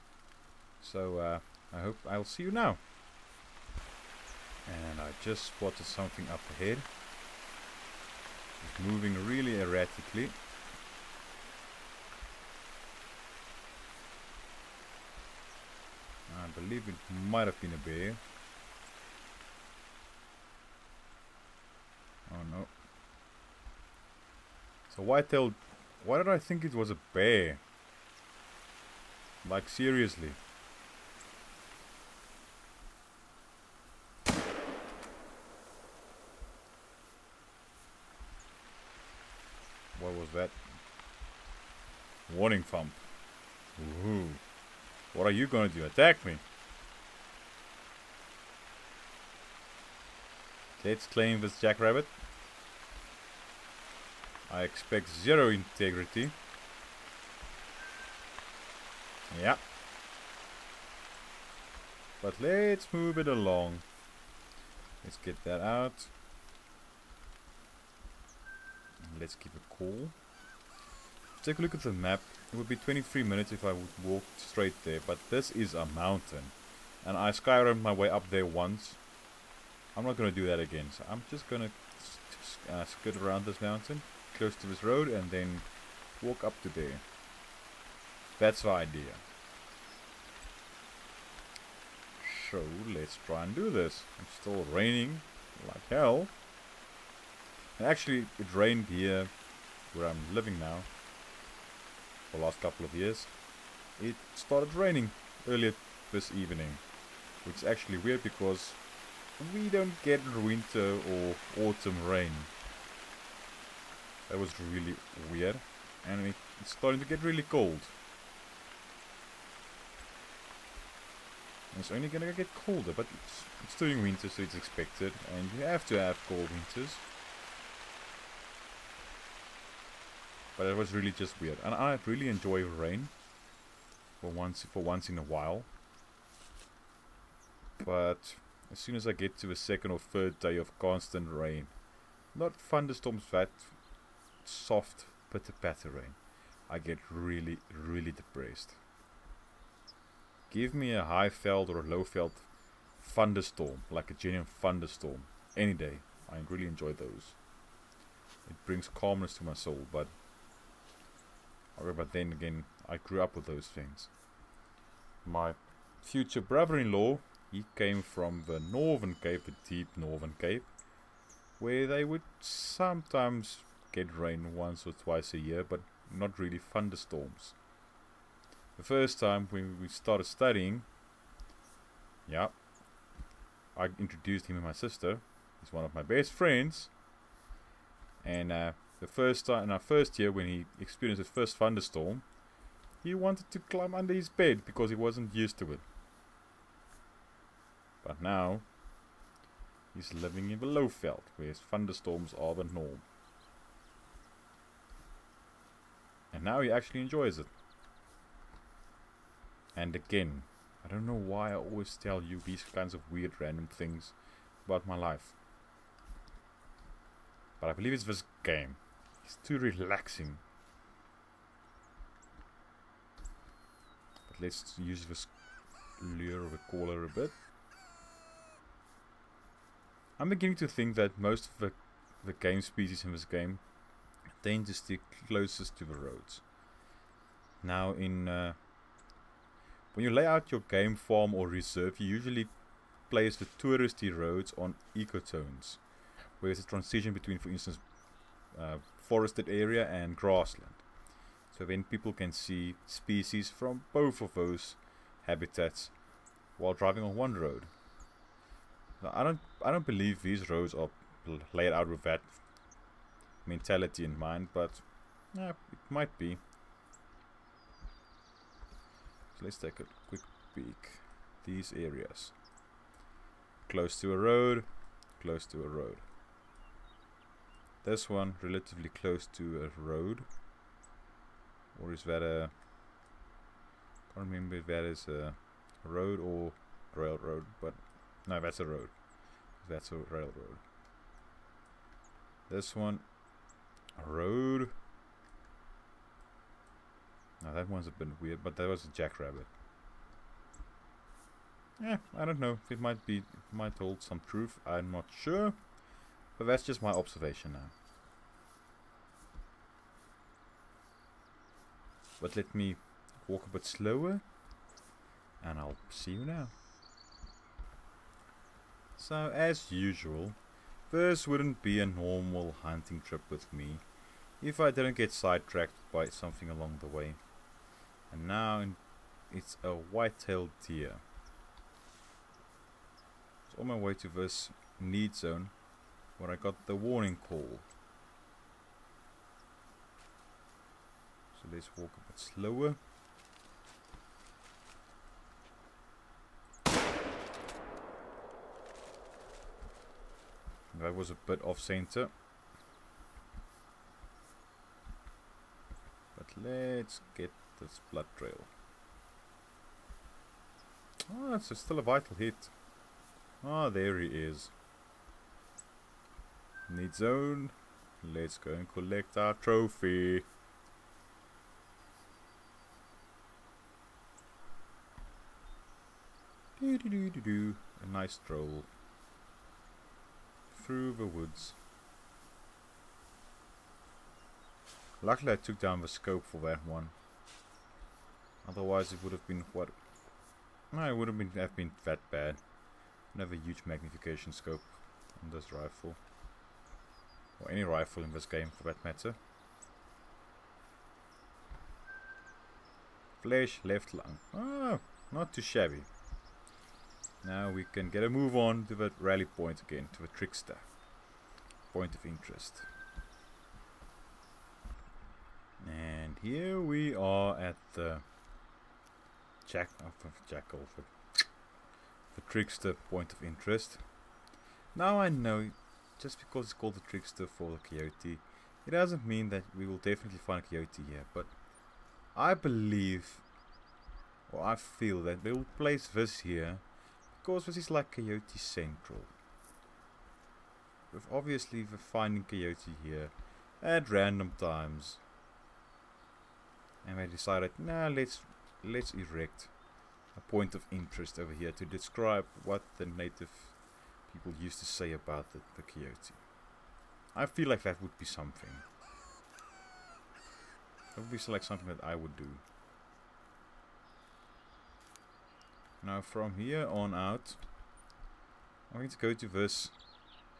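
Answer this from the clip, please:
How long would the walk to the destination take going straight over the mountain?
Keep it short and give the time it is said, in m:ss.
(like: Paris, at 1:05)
23 minutes, at 1:12.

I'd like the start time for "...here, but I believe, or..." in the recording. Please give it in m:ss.
7:10.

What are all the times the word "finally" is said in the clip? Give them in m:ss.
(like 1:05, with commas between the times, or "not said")
not said.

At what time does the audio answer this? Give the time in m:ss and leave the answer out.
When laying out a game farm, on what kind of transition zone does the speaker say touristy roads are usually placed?
4:04.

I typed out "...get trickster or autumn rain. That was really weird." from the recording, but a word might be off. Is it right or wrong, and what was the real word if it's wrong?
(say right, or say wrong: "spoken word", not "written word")
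wrong: "winter", not "trickster".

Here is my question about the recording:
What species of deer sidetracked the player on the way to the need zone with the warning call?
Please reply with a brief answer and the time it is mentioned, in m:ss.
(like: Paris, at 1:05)
White-tailed deer, at 5:29.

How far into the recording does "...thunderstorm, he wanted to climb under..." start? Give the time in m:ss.
3:11.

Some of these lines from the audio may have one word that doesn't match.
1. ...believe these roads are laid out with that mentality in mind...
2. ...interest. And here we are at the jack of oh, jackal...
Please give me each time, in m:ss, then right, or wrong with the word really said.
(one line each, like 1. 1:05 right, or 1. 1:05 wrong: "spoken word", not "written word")
1. 4:19 right
2. 6:52 right.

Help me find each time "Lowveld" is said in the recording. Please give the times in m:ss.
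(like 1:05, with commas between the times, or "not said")
2:31, 3:20.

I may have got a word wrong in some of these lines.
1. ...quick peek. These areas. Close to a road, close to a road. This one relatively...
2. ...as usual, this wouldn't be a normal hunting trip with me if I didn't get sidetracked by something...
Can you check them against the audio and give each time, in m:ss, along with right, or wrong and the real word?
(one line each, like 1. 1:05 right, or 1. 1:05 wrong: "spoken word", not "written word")
1. 4:30 right
2. 5:19 right.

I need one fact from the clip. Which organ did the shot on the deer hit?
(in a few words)
Left lung.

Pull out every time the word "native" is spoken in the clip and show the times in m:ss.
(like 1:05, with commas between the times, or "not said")
7:32.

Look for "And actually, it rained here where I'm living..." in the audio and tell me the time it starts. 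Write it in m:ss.
1:37.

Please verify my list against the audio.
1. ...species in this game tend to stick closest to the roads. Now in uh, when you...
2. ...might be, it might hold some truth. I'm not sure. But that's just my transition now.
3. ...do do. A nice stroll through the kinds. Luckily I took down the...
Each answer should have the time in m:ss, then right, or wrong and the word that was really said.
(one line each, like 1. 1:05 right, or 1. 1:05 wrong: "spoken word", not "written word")
1. 3:52 right
2. 5:02 wrong: "observation", not "transition"
3. 6:17 wrong: "woods", not "kinds".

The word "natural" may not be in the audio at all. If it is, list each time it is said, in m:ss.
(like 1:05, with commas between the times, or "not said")
not said.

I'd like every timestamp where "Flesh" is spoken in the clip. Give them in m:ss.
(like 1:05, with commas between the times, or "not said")
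6:43.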